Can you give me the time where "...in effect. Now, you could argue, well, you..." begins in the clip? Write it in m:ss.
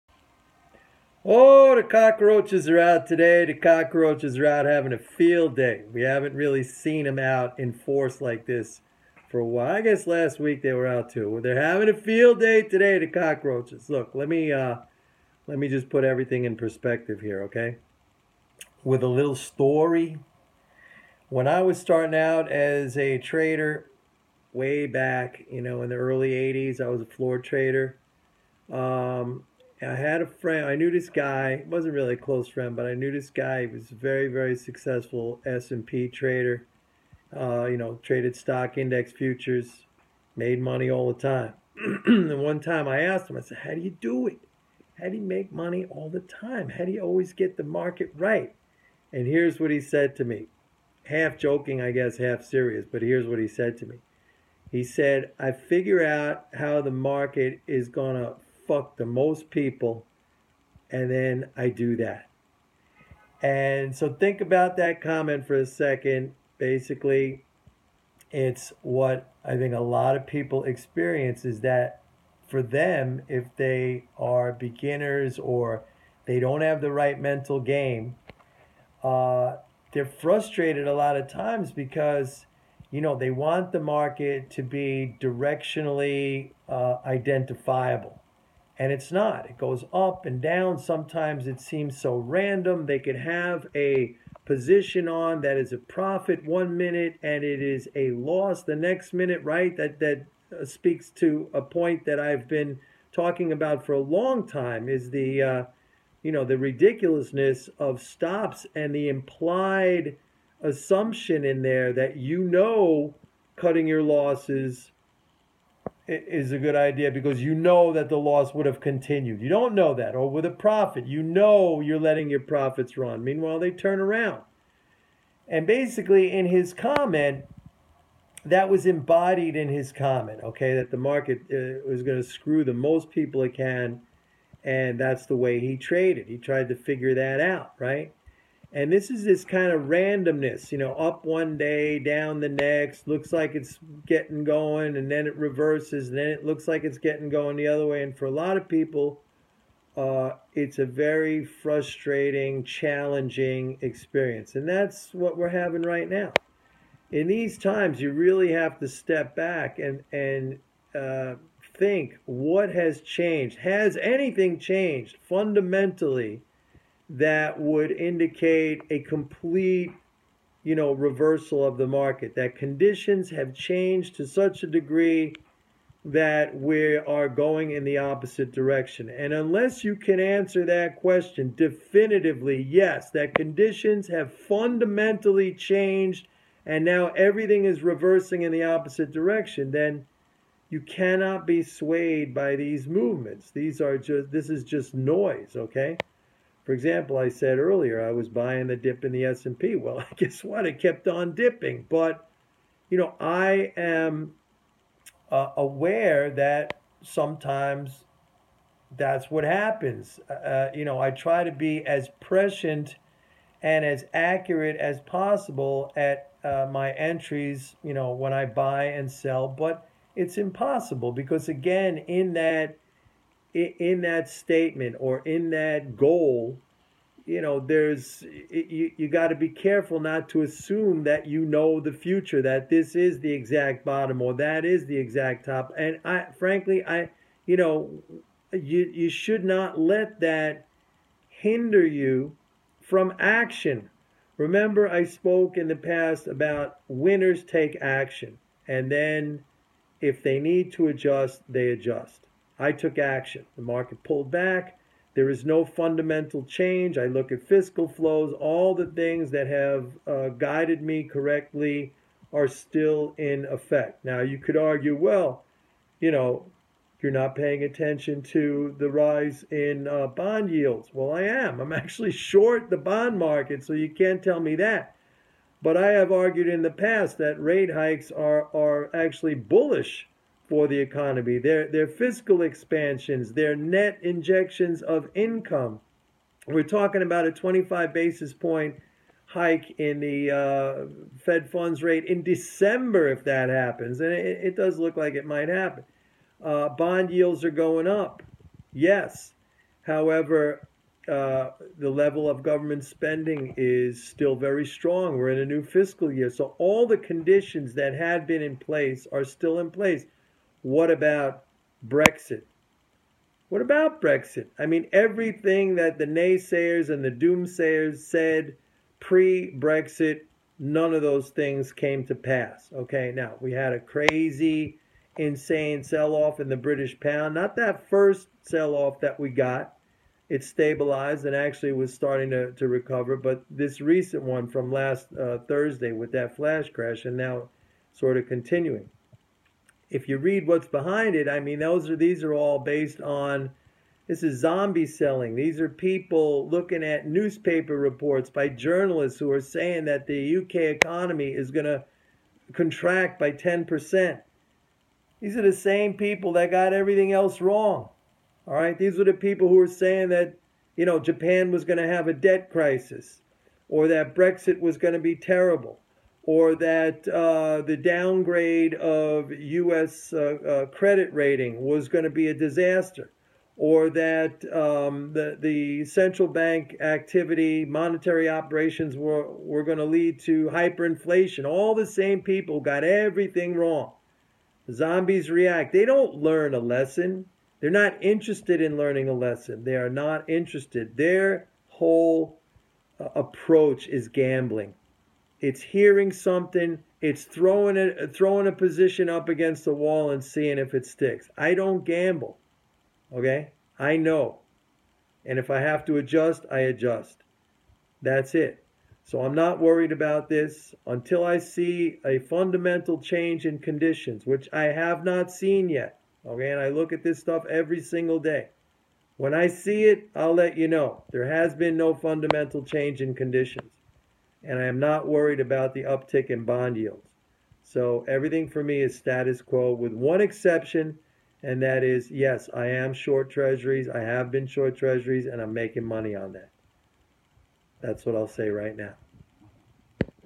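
4:23.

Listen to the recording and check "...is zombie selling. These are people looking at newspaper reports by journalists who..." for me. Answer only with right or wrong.
right.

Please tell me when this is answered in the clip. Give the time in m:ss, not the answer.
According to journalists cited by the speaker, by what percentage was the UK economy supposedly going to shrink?
5:53.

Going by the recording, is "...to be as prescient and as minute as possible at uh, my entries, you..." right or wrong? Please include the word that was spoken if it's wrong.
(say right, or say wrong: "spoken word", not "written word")
wrong: "accurate", not "minute".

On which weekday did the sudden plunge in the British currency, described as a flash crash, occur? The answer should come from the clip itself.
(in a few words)
Thursday.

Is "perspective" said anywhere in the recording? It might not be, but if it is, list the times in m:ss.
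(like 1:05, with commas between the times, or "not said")
0:16.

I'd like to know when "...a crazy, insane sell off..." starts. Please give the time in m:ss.
5:23.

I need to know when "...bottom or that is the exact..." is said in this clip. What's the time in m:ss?
3:53.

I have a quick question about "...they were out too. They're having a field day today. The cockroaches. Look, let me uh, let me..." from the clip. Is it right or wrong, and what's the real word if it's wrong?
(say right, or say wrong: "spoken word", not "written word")
right.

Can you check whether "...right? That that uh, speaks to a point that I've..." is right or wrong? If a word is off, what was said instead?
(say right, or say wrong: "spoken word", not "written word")
right.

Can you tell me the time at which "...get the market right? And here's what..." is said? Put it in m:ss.
0:47.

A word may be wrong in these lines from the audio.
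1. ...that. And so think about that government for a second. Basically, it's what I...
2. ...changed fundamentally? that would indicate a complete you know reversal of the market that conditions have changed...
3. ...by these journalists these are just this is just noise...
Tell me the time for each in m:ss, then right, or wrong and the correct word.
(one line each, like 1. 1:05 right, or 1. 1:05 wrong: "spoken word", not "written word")
1. 1:01 wrong: "comment", not "government"
2. 2:44 right
3. 3:12 wrong: "movements", not "journalists".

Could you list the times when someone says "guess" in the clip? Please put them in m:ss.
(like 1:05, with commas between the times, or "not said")
0:09, 0:51, 3:20.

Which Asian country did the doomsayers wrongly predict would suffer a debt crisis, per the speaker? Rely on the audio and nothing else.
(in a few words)
Japan.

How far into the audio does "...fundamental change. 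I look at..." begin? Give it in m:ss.
4:15.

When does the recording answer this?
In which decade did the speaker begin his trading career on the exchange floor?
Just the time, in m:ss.
0:25.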